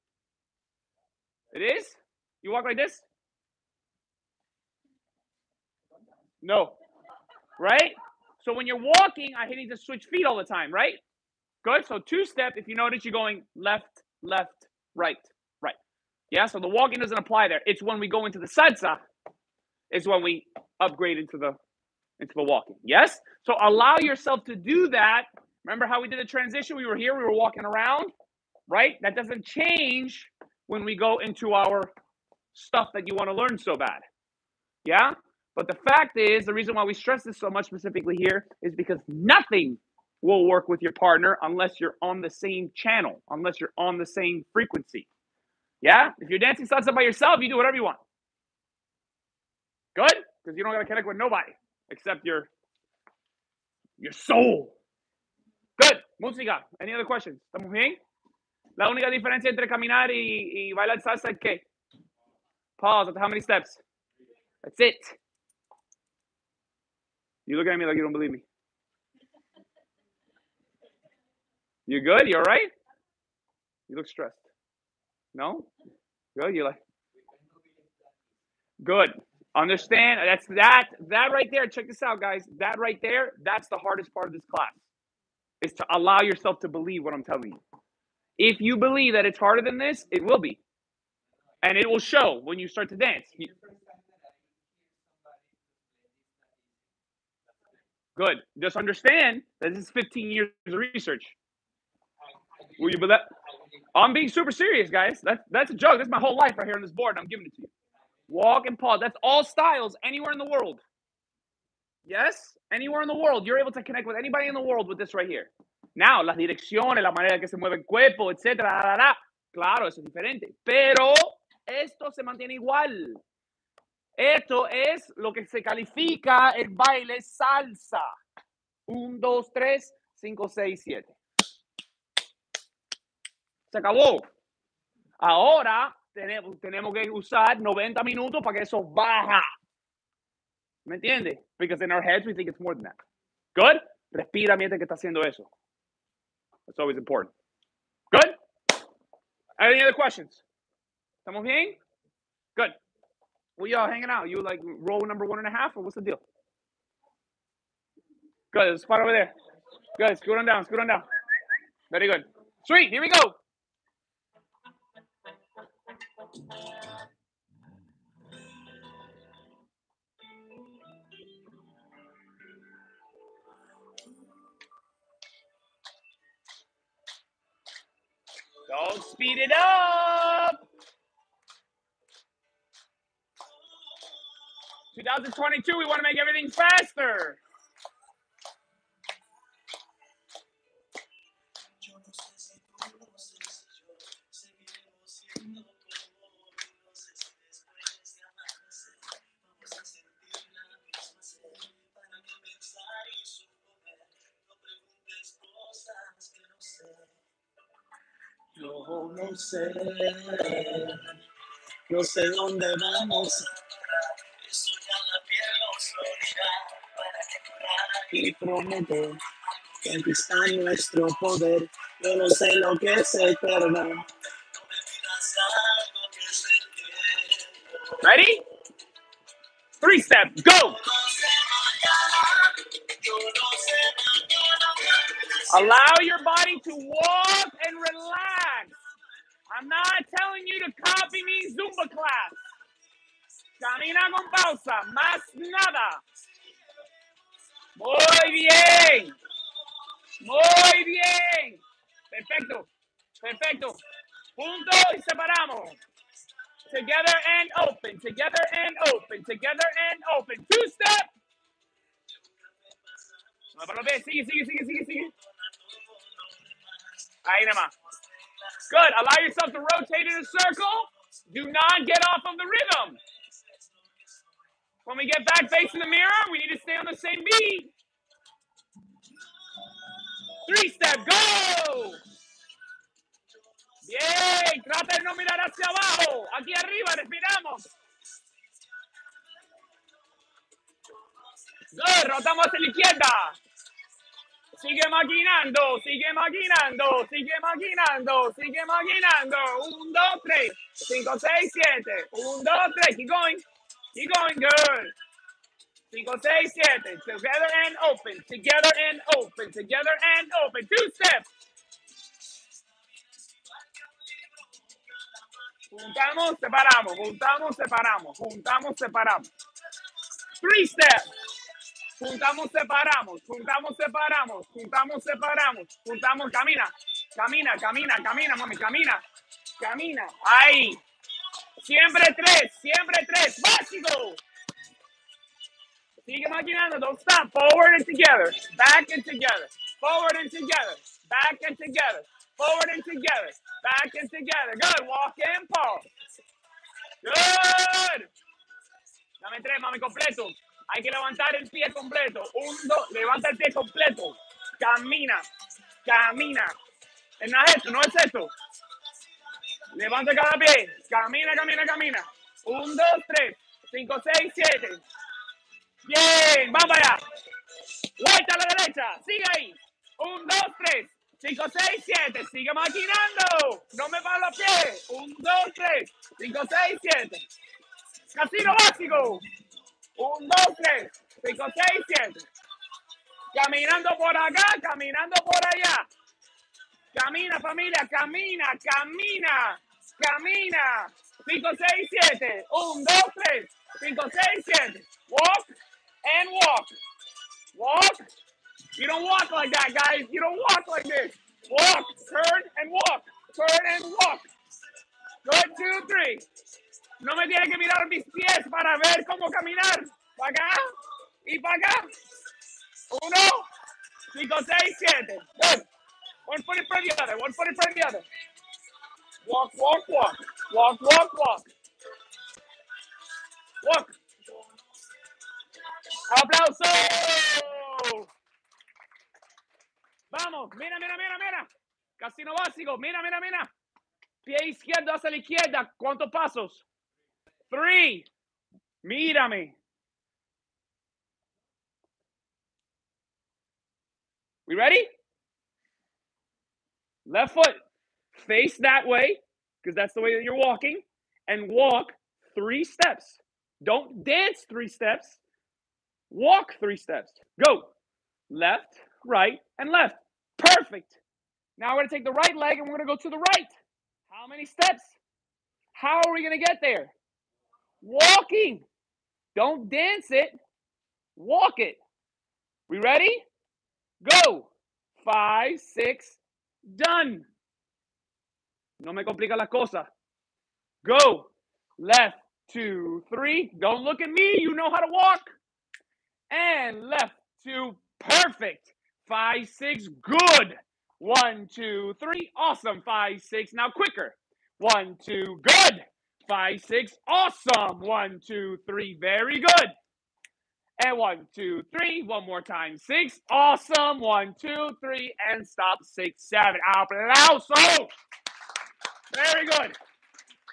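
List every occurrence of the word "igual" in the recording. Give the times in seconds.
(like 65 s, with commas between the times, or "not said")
122 s.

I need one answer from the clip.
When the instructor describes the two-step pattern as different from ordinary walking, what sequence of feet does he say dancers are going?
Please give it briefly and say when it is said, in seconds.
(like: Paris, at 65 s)
left, left, right, right, at 13 s.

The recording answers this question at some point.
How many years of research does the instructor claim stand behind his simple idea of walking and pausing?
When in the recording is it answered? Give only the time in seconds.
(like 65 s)
99 s.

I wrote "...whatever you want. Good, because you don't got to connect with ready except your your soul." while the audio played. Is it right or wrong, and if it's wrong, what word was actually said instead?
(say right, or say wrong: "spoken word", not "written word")
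wrong: "nobody", not "ready".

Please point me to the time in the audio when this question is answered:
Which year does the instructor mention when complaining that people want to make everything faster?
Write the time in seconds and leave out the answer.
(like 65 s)
184 s.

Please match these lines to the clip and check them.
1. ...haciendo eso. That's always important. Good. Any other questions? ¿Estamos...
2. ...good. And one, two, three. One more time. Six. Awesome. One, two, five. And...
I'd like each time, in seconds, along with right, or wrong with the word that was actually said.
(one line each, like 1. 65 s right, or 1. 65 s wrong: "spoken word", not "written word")
1. 144 s right
2. 499 s wrong: "three", not "five".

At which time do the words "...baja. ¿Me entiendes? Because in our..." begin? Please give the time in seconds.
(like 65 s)
138 s.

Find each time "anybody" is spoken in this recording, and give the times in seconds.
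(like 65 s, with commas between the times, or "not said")
114 s.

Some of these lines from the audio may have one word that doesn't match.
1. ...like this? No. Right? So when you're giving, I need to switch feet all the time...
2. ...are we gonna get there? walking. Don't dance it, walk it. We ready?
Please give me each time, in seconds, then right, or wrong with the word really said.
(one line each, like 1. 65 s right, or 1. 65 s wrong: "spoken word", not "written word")
1. 2 s wrong: "walking", not "giving"
2. 466 s right.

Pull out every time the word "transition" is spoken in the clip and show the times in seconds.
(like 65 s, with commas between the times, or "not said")
26 s.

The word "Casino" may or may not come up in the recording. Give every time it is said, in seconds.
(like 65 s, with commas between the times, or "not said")
378 s, 431 s.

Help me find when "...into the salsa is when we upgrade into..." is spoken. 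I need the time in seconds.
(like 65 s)
18 s.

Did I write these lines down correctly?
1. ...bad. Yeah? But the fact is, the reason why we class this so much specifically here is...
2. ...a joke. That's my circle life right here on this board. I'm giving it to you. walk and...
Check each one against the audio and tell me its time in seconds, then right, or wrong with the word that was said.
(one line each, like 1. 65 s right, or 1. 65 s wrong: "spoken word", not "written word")
1. 33 s wrong: "stress", not "class"
2. 105 s wrong: "whole", not "circle".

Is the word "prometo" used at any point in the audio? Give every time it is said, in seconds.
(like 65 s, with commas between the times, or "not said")
218 s.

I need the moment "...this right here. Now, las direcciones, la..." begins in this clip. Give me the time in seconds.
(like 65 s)
114 s.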